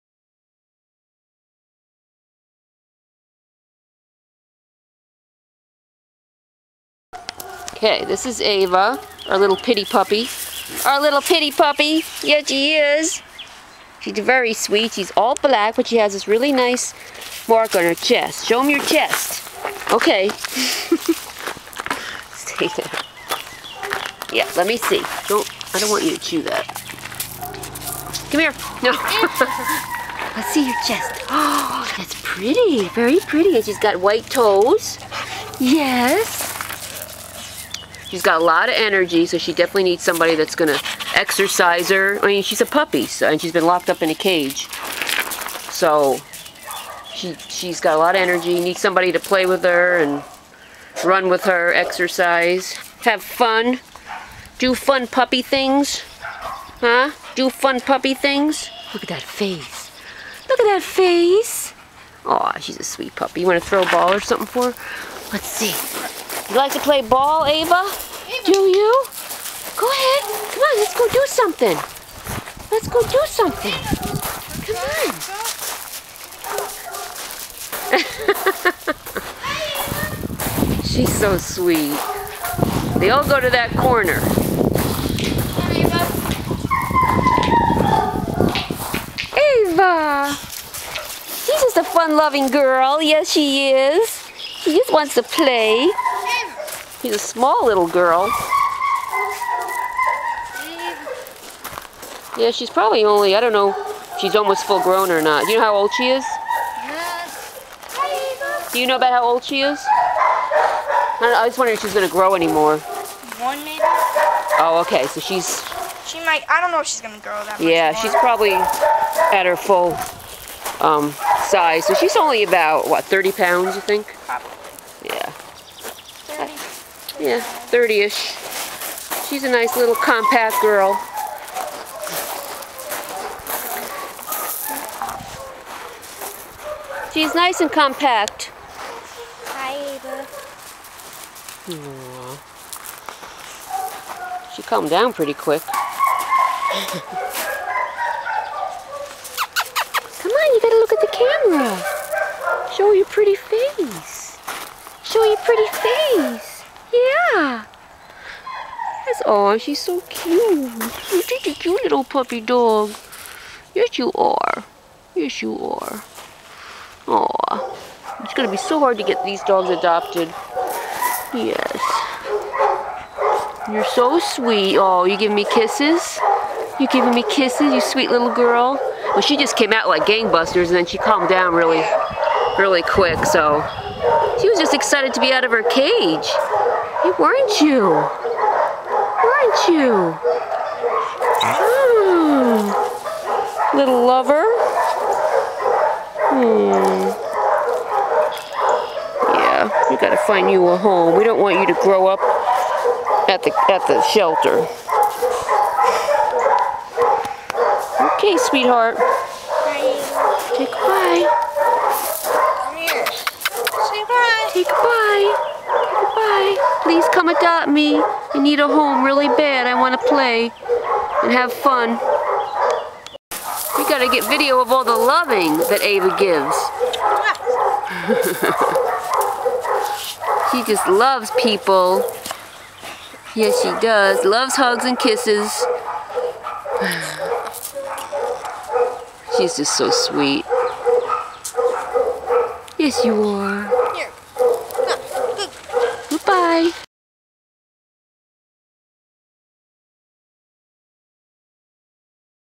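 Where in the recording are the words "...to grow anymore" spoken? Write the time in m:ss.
1:52.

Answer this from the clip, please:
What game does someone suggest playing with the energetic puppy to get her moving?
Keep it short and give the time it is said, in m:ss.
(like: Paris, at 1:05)
throw a ball, at 1:03.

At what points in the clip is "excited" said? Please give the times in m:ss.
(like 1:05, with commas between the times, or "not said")
3:04.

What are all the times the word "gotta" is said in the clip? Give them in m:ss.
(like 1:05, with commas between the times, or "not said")
2:30, 3:19, 3:43.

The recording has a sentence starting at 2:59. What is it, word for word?
Well, she just came out like gangbusters and then she calmed down really, really quick, so.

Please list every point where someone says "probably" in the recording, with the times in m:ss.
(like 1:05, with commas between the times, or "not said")
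1:42, 1:58.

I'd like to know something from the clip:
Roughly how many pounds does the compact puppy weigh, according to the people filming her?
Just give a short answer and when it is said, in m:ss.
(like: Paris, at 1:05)
30, at 2:03.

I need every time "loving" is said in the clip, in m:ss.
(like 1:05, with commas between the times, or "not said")
1:31, 3:44.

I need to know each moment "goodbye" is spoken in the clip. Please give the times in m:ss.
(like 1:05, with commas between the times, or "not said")
3:30, 3:34.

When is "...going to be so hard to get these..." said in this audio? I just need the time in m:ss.
2:48.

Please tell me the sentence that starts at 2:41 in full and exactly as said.
You're such a cute little puppy dog.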